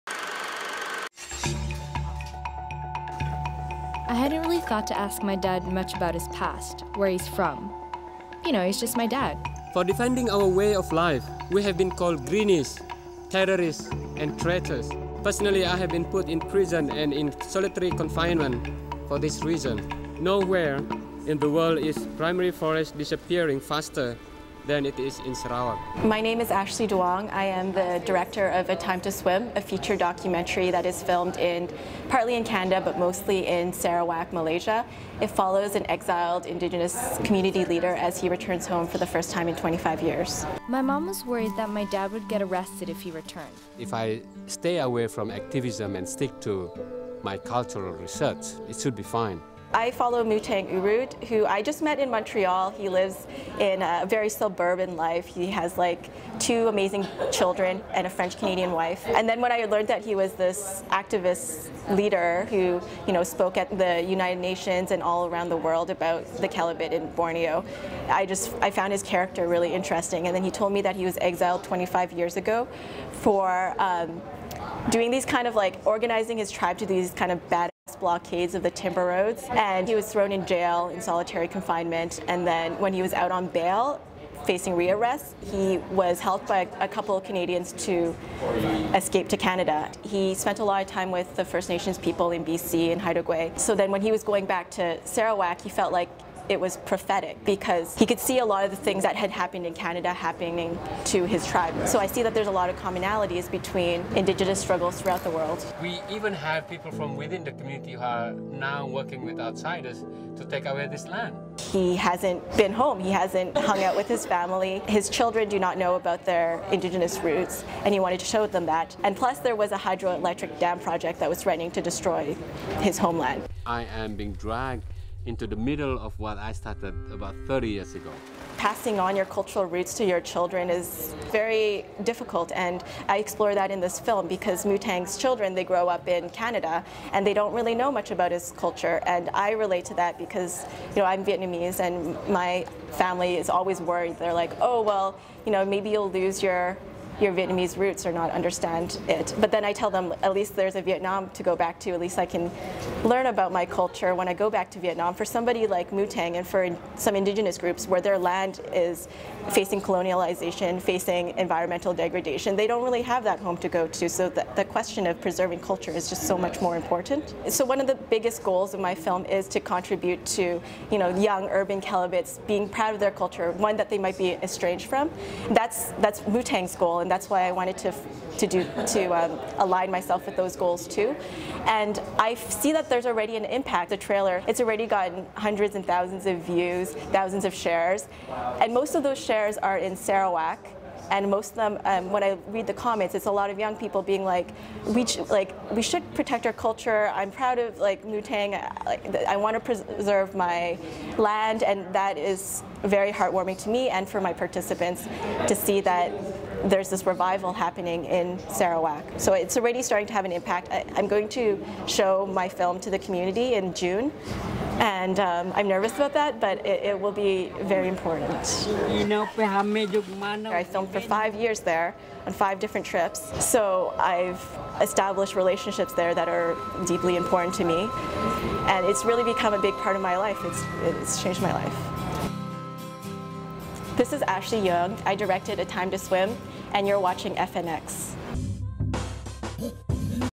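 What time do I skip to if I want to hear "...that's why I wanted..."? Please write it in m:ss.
2:57.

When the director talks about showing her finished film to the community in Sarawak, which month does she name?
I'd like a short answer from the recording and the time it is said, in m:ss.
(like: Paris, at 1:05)
June, at 3:33.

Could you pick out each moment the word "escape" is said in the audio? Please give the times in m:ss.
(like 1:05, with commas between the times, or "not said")
1:28.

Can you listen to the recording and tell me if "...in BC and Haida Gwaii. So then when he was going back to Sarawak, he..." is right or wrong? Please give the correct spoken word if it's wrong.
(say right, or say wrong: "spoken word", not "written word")
right.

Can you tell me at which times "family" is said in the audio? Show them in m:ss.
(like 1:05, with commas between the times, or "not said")
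1:54, 2:22.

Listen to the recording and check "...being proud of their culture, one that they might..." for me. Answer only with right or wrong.
right.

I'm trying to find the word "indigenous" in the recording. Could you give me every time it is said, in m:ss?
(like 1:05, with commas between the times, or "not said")
0:36, 1:44, 1:56, 2:37.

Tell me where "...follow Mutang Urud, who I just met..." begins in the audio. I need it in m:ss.
0:49.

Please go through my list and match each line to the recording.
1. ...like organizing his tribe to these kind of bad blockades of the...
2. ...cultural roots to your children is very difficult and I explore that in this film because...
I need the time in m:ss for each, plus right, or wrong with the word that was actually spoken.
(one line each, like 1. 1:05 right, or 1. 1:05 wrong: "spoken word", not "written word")
1. 1:15 right
2. 2:09 right.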